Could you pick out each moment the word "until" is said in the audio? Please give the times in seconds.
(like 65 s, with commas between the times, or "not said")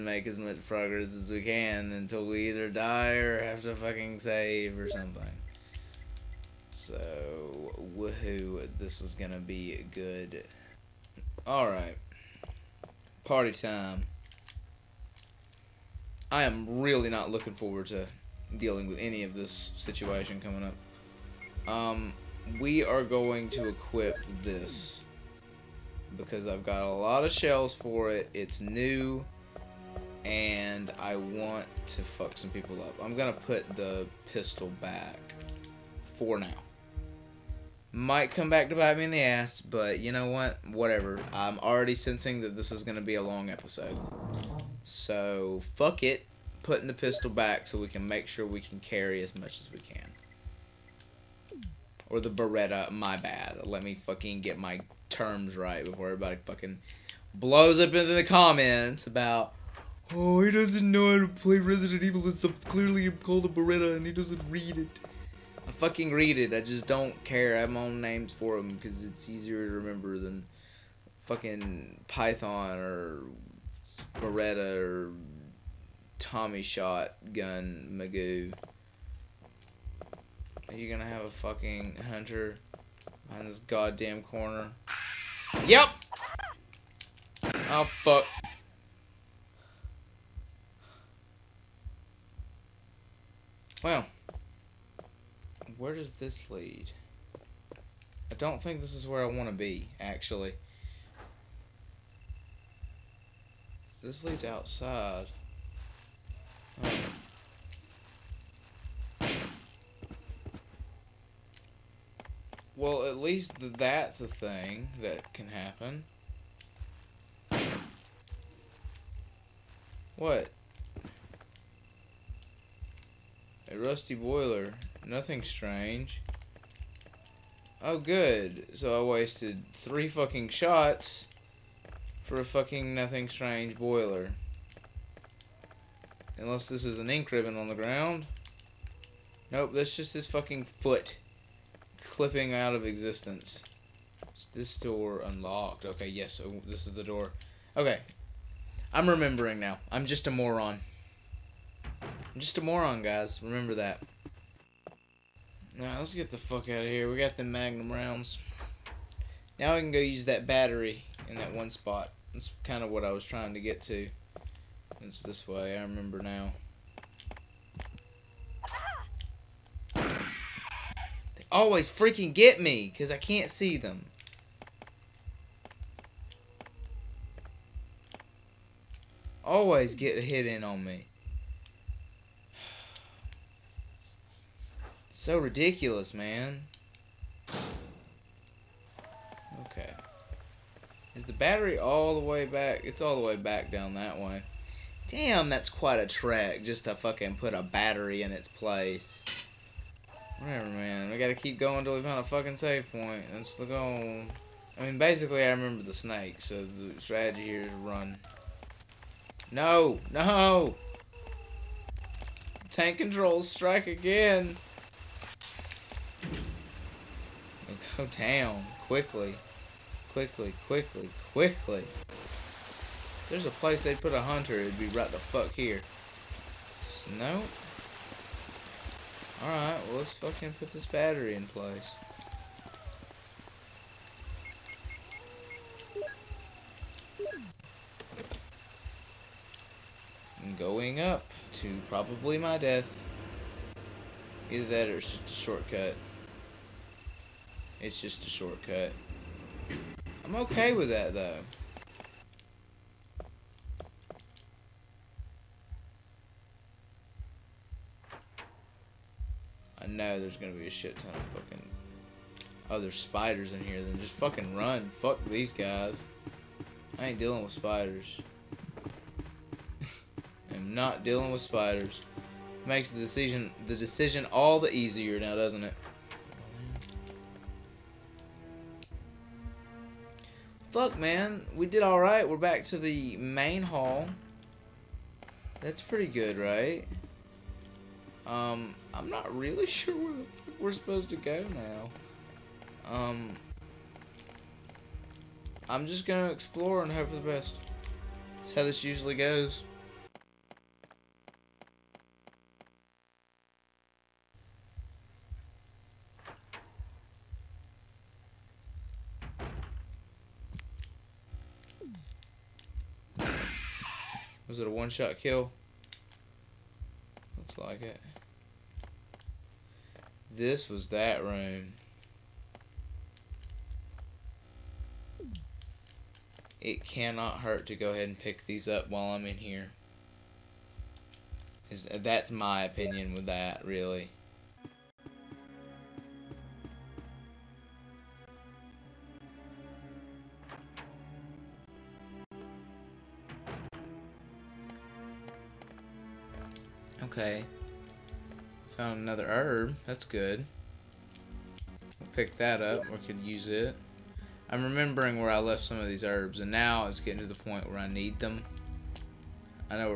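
1 s, 201 s.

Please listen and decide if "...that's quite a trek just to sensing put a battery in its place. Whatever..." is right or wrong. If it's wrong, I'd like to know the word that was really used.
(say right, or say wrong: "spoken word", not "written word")
wrong: "fucking", not "sensing".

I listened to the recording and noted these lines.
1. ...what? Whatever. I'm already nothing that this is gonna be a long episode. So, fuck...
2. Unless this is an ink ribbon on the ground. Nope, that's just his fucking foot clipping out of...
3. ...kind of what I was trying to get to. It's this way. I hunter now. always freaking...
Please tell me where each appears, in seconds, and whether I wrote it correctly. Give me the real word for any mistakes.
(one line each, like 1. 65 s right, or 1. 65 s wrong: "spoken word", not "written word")
1. 40 s wrong: "sensing", not "nothing"
2. 136 s right
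3. 162 s wrong: "remember", not "hunter".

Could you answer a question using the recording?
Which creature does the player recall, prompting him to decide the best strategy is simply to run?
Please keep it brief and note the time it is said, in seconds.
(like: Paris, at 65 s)
The snake, at 205 s.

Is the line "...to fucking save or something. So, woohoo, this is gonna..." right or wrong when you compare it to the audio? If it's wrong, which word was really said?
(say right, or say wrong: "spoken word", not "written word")
right.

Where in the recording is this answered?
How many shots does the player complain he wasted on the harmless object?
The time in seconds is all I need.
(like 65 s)
129 s.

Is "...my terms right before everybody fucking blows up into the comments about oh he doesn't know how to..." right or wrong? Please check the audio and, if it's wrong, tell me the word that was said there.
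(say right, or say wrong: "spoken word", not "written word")
right.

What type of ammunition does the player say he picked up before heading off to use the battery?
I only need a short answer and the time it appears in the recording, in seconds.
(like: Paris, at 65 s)
Magnum rounds, at 157 s.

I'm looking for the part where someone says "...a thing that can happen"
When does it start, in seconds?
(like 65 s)
114 s.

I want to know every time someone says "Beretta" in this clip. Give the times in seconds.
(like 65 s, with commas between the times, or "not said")
52 s, 63 s, 74 s.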